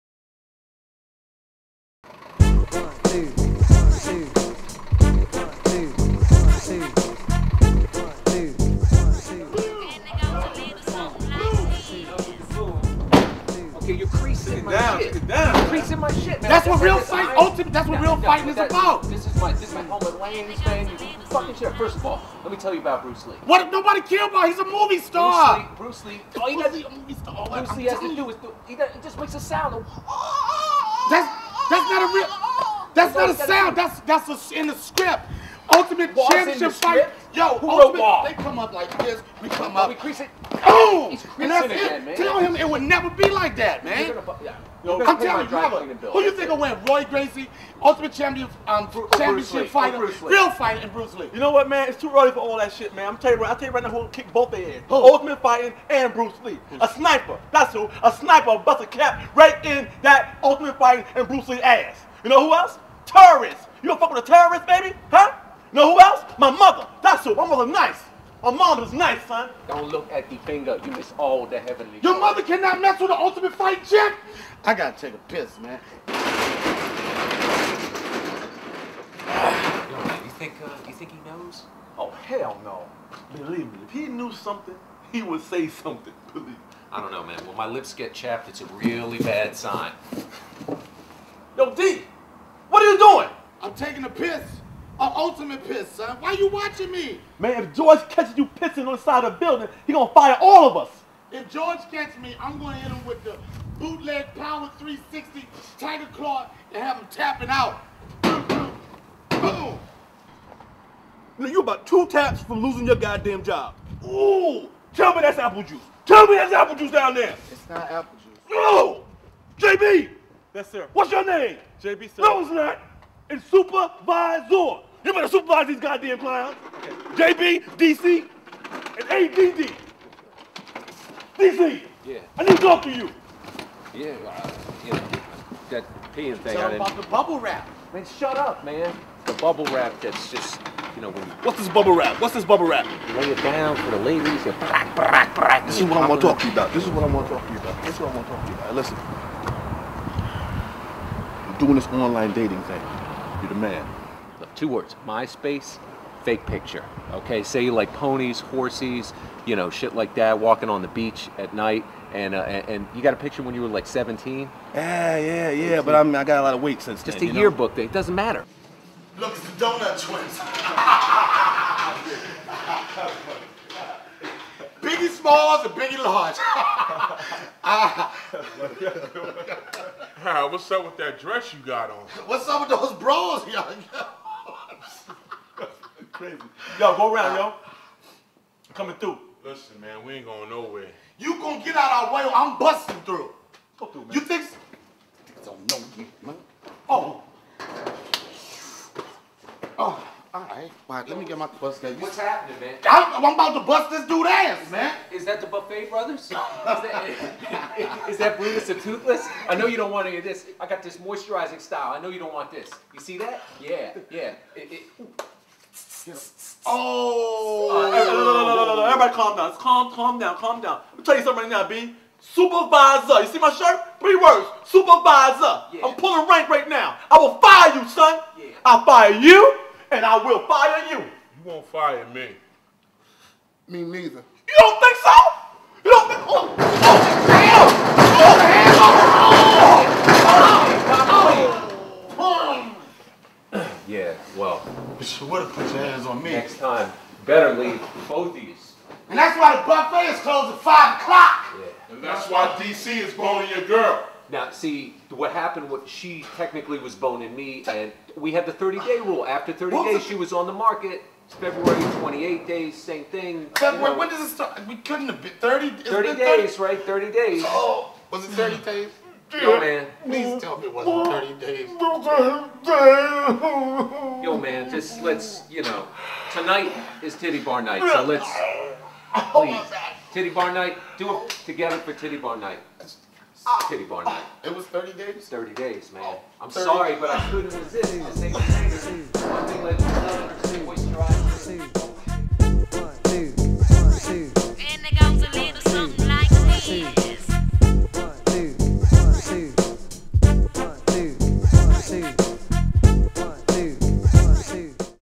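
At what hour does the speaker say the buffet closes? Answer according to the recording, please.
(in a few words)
5 o'clock.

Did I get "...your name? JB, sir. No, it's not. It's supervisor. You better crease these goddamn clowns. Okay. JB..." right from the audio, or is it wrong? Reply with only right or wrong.
wrong.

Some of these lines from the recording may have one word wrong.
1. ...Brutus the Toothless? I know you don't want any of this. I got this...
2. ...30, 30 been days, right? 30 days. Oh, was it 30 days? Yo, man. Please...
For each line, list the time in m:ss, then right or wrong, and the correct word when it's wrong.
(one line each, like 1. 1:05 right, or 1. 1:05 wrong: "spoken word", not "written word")
1. 3:28 right
2. 4:25 right.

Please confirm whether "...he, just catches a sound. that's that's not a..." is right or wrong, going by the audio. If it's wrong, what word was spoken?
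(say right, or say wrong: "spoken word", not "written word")
wrong: "makes", not "catches".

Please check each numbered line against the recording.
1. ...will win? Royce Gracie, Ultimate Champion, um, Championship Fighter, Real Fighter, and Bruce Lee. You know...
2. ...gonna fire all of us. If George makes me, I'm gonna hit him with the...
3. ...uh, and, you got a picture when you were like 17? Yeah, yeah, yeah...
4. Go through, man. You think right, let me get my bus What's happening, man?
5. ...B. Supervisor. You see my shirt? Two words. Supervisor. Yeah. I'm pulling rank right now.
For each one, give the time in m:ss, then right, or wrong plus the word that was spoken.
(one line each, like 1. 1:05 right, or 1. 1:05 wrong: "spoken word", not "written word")
1. 0:46 right
2. 1:39 wrong: "catches", not "makes"
3. 2:42 right
4. 3:13 right
5. 3:41 wrong: "Three", not "Two".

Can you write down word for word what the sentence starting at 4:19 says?
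After 30 days, she was on the market.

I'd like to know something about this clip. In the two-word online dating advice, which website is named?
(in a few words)
MySpace.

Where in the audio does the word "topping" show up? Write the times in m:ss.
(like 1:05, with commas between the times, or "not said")
not said.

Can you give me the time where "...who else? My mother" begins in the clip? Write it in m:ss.
1:05.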